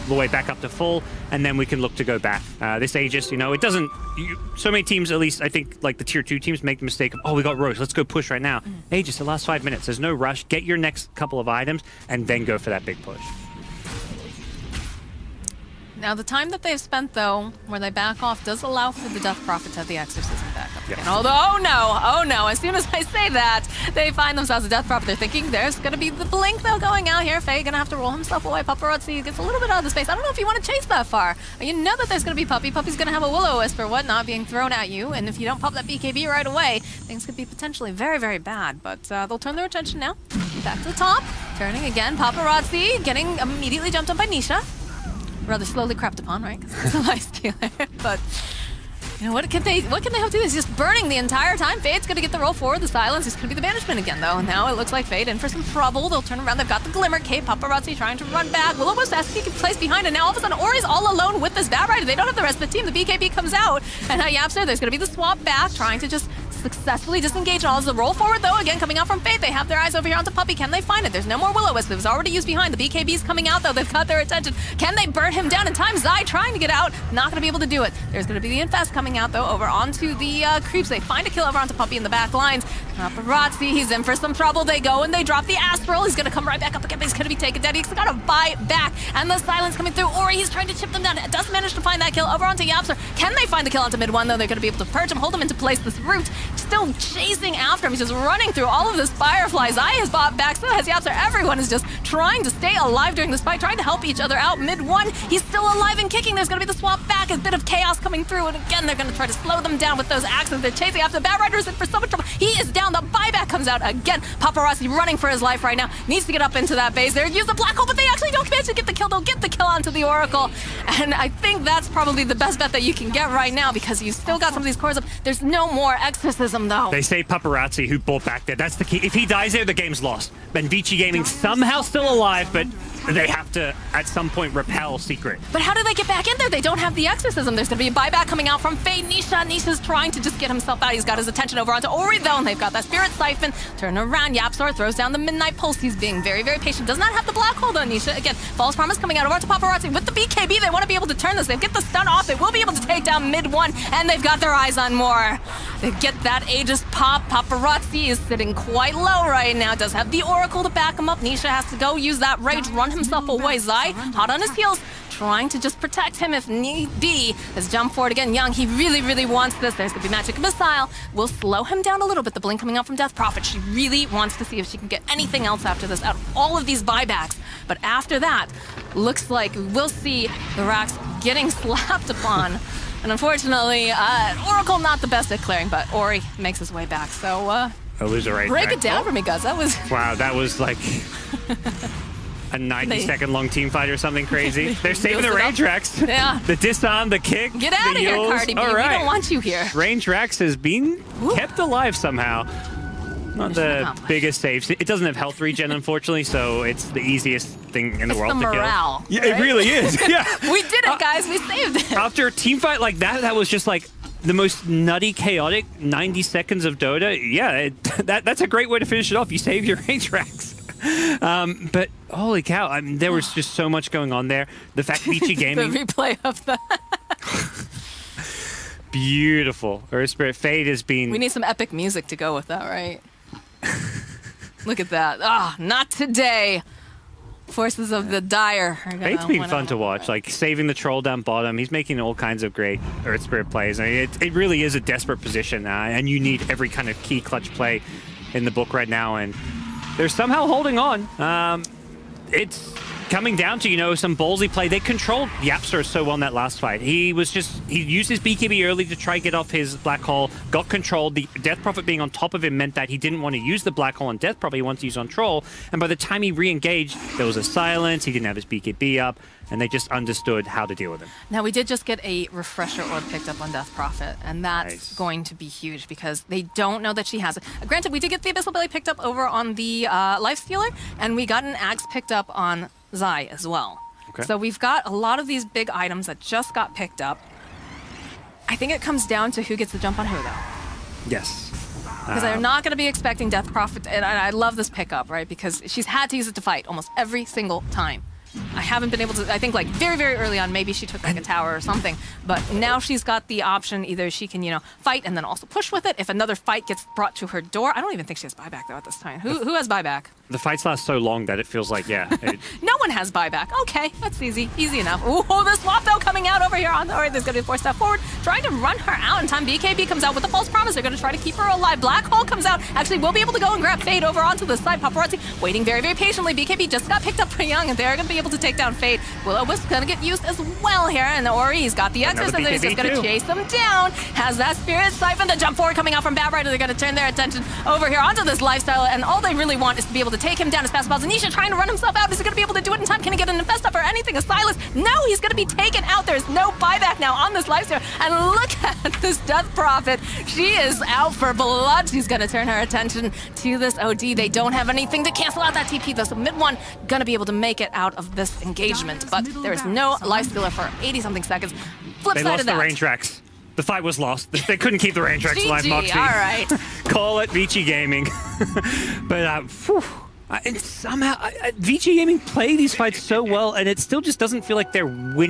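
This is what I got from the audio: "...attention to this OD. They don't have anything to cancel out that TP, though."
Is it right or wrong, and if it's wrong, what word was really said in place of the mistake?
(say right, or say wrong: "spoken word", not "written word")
right.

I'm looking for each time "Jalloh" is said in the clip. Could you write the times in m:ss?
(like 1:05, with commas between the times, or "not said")
not said.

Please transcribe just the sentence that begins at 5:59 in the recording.
But there is no lifestealer for 80-something seconds.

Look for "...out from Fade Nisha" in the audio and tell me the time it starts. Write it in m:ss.
2:18.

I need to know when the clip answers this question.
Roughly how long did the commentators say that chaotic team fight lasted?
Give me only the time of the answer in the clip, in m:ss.
3:35.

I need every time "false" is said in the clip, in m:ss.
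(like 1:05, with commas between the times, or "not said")
2:28, 5:20.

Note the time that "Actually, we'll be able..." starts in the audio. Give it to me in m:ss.
5:22.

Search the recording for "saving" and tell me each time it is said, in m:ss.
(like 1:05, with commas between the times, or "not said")
3:14, 4:00.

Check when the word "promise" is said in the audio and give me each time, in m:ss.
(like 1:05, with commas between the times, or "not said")
2:28, 5:20.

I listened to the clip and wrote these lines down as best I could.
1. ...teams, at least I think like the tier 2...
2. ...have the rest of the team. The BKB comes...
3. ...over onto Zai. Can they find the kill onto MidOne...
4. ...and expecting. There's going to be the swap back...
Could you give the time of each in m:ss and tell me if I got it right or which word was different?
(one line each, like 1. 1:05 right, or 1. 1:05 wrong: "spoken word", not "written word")
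1. 0:04 right
2. 1:02 right
3. 1:32 wrong: "YapzOr", not "Zai"
4. 1:45 wrong: "kicking", not "expecting".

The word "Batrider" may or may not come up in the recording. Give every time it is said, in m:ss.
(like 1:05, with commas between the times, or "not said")
1:01, 1:51, 5:36.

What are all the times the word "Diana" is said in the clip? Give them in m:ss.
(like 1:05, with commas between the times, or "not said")
not said.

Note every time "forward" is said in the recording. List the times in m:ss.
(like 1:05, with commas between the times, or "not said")
0:52, 1:08, 2:47, 5:17, 5:35.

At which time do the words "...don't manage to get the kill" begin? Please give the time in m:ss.
1:58.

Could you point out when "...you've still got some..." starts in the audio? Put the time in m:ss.
2:04.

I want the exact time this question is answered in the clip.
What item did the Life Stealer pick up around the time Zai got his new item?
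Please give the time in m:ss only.
4:38.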